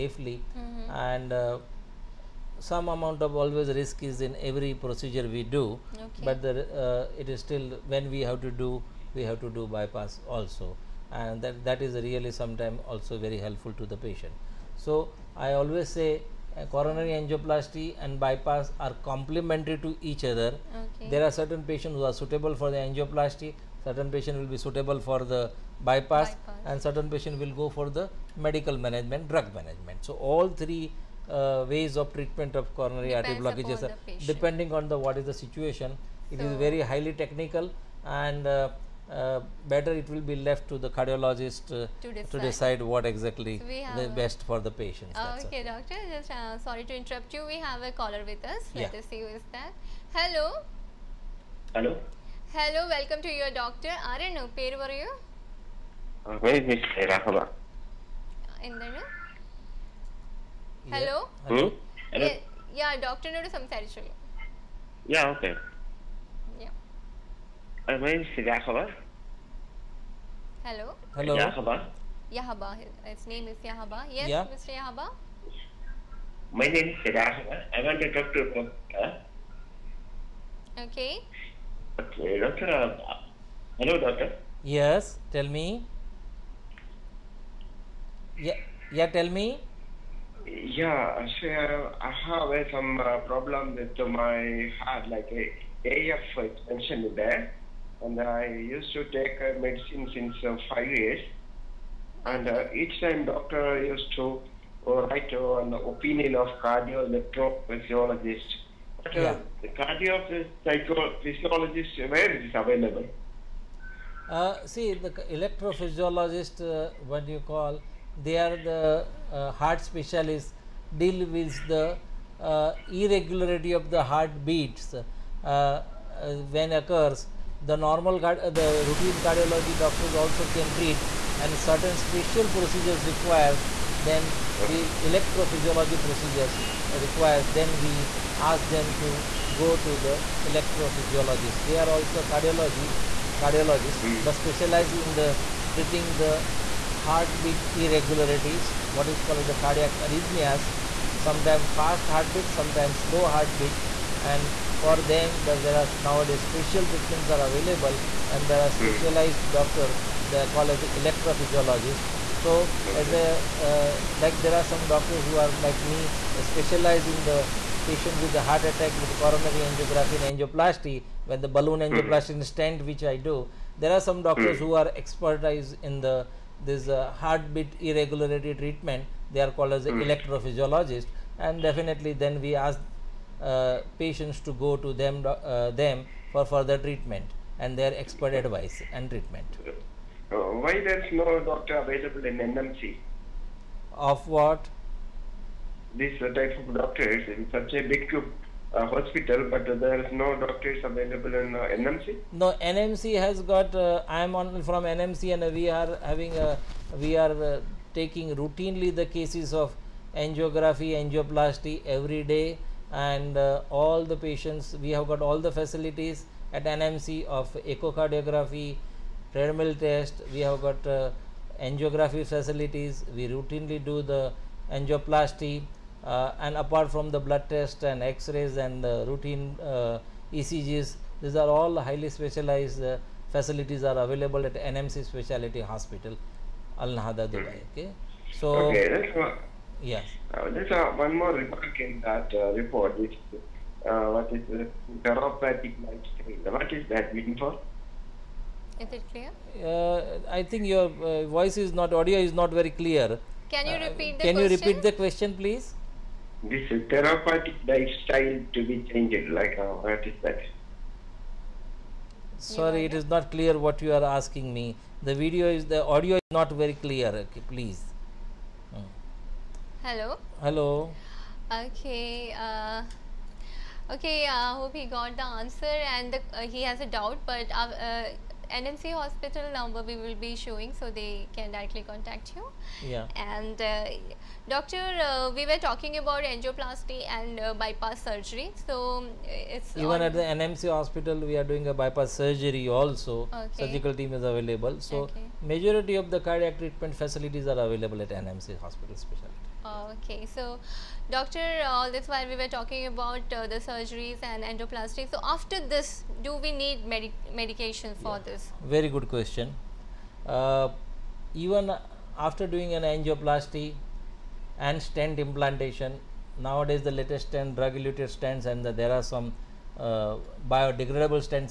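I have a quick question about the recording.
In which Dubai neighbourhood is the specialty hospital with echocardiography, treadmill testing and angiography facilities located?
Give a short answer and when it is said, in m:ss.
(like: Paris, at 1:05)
Al Nahda, at 3:56.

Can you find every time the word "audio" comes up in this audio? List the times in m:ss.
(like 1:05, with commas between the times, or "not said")
4:11, 4:25.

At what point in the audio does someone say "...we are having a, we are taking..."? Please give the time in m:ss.
3:25.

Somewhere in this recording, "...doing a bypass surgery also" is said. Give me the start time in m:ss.
4:51.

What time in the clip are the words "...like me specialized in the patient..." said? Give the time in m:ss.
2:45.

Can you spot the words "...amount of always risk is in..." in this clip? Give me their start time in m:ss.
0:02.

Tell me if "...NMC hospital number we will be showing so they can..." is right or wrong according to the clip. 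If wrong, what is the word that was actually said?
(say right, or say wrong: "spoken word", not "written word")
right.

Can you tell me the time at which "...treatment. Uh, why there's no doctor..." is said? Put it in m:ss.
3:09.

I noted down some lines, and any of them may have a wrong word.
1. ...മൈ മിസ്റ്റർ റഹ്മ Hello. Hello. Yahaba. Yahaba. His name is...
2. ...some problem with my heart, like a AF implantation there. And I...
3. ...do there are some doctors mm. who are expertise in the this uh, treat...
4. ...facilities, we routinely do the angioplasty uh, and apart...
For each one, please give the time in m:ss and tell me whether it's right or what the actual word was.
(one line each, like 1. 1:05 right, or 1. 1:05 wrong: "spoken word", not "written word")
1. 1:08 right
2. 1:32 wrong: "extension", not "implantation"
3. 2:53 wrong: "heartbeat", not "treat"
4. 3:42 right.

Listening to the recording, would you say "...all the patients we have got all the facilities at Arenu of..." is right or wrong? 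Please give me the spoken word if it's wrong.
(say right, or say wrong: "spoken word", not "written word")
wrong: "NMC", not "Arenu".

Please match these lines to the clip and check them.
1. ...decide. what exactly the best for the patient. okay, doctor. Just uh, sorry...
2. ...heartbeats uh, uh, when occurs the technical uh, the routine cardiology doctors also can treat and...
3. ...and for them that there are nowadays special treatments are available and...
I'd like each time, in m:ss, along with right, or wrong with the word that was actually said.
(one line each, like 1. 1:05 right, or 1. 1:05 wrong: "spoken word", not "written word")
1. 0:42 right
2. 2:04 wrong: "normal", not "technical"
3. 2:34 right.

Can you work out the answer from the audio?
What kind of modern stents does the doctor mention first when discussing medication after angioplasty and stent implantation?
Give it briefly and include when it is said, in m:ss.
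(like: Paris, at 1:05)
drug-eluted stents, at 5:17.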